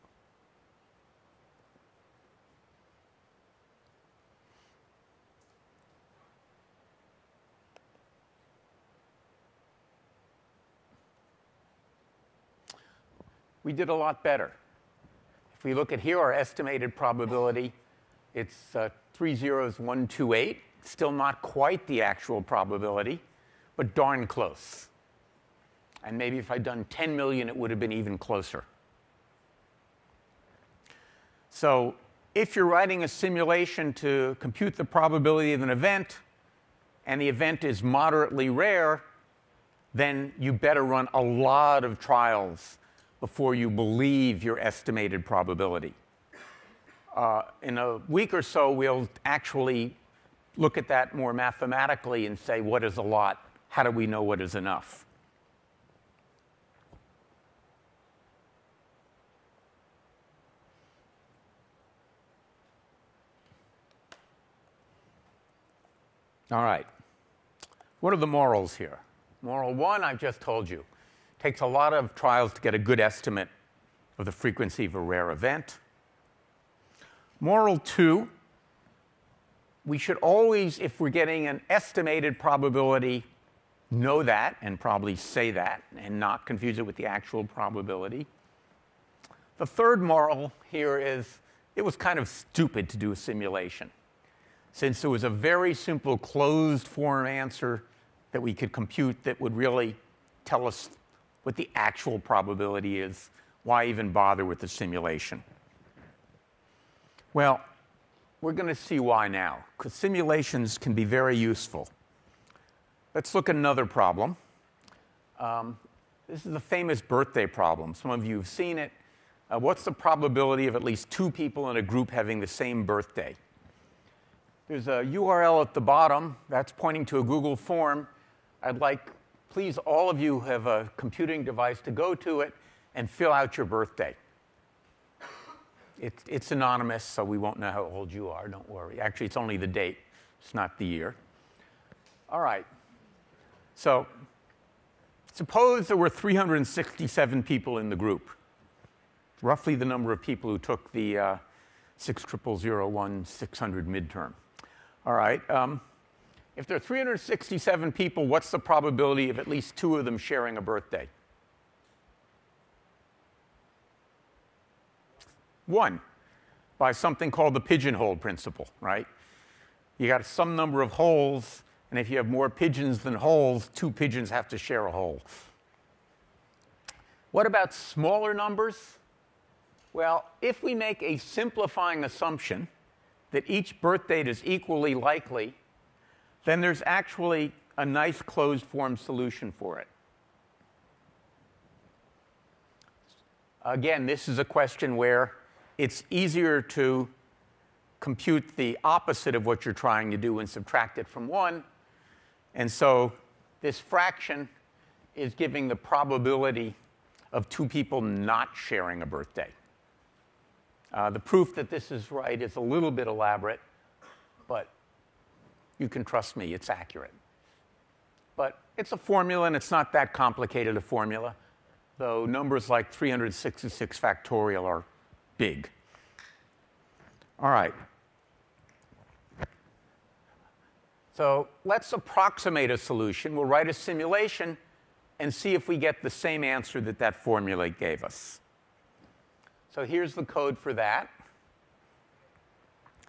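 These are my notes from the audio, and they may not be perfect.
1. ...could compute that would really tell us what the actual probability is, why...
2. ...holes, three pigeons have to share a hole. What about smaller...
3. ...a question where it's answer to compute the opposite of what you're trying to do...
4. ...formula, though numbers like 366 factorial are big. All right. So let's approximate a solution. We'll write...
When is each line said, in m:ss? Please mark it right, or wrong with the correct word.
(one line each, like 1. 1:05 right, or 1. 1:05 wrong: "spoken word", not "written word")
1. 1:38 right
2. 2:53 wrong: "two", not "three"
3. 3:14 wrong: "easier", not "answer"
4. 3:40 right.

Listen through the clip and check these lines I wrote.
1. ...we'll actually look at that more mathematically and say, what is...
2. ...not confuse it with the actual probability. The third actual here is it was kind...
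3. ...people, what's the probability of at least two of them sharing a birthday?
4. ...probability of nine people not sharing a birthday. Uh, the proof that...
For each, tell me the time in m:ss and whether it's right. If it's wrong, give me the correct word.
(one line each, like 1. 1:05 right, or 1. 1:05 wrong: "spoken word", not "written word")
1. 0:48 right
2. 1:26 wrong: "moral", not "actual"
3. 2:37 right
4. 3:25 wrong: "two", not "nine".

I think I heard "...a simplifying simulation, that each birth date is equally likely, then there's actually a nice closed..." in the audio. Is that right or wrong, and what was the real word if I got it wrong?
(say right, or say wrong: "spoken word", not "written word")
wrong: "assumption", not "simulation".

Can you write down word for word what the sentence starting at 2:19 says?
Actually, it's only the date, it's not the year.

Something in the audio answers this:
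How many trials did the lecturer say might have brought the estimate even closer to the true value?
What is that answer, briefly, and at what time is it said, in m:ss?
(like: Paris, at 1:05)
10 million, at 0:26.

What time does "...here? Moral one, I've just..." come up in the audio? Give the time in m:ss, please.
1:08.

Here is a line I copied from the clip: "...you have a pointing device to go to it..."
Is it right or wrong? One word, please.
wrong.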